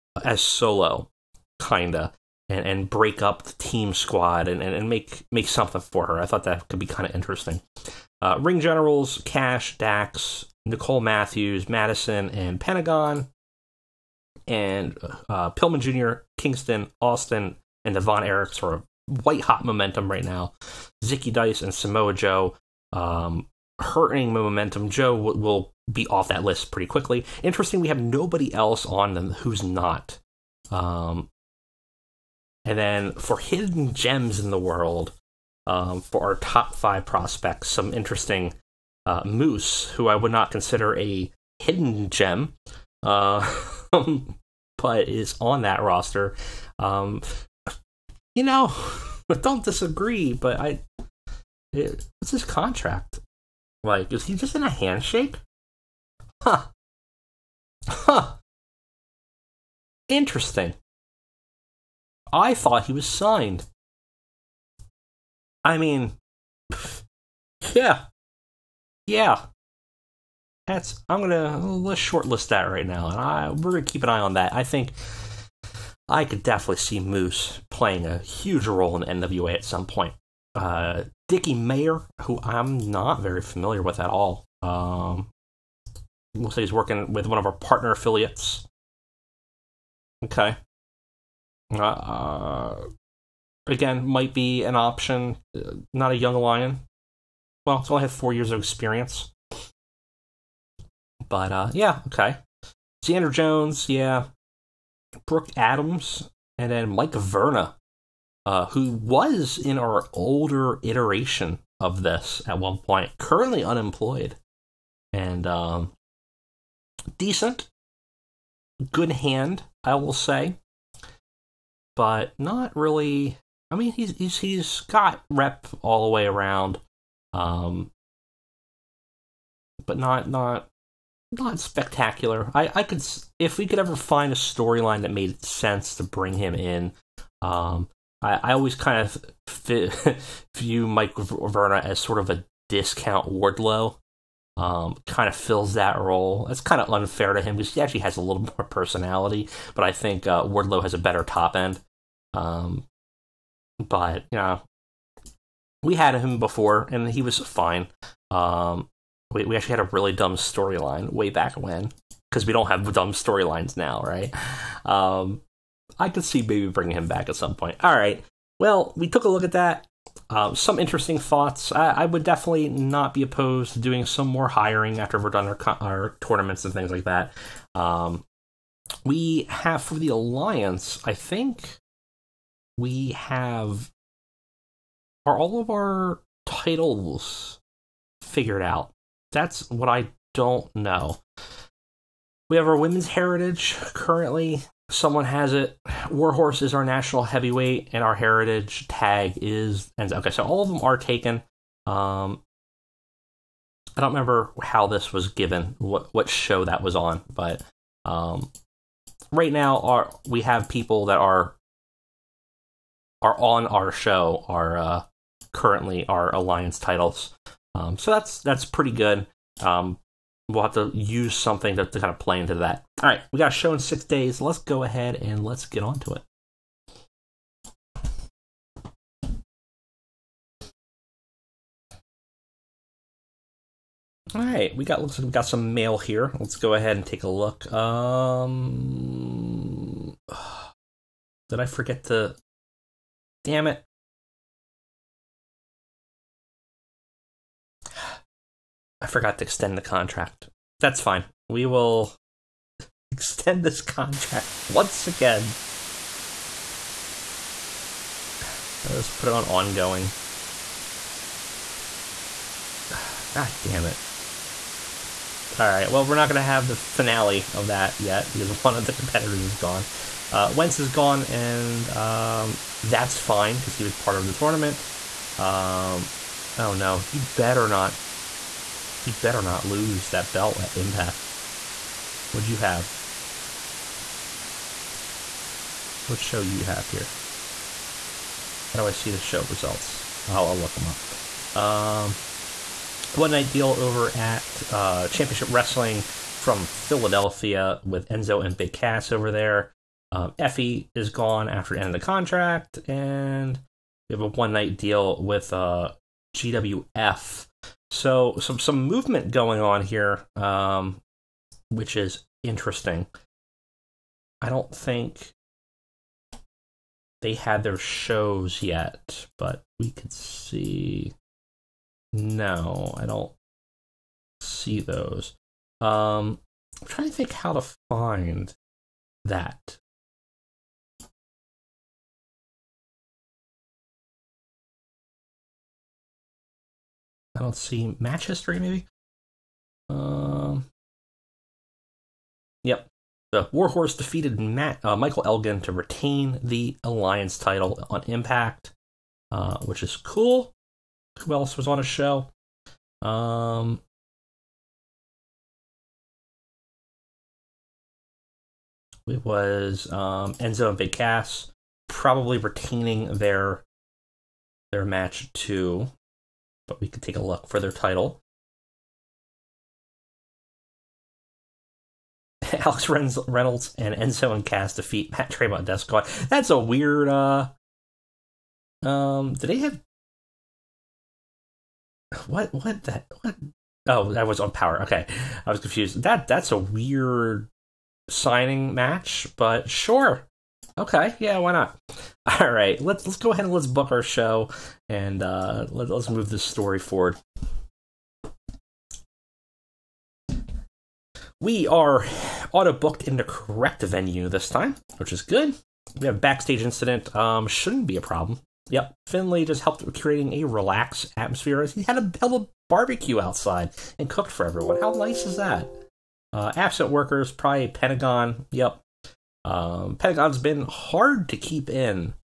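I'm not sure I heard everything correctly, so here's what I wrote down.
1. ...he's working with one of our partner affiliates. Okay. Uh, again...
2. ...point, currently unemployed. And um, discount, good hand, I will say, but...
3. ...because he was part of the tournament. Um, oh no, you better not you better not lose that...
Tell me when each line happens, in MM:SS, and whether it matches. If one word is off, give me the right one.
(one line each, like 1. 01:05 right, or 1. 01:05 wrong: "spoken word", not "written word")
1. 01:26 right
2. 01:52 wrong: "decent", not "discount"
3. 04:33 right.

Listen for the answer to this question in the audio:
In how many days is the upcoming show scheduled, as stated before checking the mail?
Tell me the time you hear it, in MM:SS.
03:43.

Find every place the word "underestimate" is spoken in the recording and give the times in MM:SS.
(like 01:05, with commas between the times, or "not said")
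not said.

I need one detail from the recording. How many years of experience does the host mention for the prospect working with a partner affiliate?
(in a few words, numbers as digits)
4.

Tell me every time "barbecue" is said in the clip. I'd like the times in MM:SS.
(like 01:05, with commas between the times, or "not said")
06:52.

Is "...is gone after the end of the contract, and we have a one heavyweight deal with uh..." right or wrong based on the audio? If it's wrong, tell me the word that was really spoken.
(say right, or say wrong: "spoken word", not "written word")
wrong: "night", not "heavyweight".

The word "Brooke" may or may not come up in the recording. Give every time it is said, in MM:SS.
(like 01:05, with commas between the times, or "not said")
01:45.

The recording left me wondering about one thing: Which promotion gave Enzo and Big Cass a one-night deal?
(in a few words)
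Championship Wrestling from Philadelphia.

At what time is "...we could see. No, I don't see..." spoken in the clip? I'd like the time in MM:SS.
05:19.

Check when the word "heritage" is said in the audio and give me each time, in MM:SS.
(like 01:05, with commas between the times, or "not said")
03:13, 03:18.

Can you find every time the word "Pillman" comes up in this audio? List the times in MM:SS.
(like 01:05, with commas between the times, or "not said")
00:15.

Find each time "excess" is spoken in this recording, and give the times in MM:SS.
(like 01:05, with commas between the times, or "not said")
not said.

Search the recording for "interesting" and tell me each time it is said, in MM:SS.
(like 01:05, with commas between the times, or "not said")
00:07, 00:27, 00:37, 01:00, 02:50, 05:12.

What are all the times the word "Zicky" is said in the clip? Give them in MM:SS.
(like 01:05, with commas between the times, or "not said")
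00:21.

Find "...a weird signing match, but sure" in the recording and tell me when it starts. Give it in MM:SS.
06:26.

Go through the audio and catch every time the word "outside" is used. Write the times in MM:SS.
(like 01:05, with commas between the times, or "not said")
06:53.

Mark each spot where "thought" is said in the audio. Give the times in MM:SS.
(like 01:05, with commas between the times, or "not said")
00:06, 01:02, 02:51.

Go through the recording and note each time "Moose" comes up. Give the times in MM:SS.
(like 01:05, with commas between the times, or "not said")
00:39, 01:16.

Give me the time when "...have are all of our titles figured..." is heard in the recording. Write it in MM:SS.
03:03.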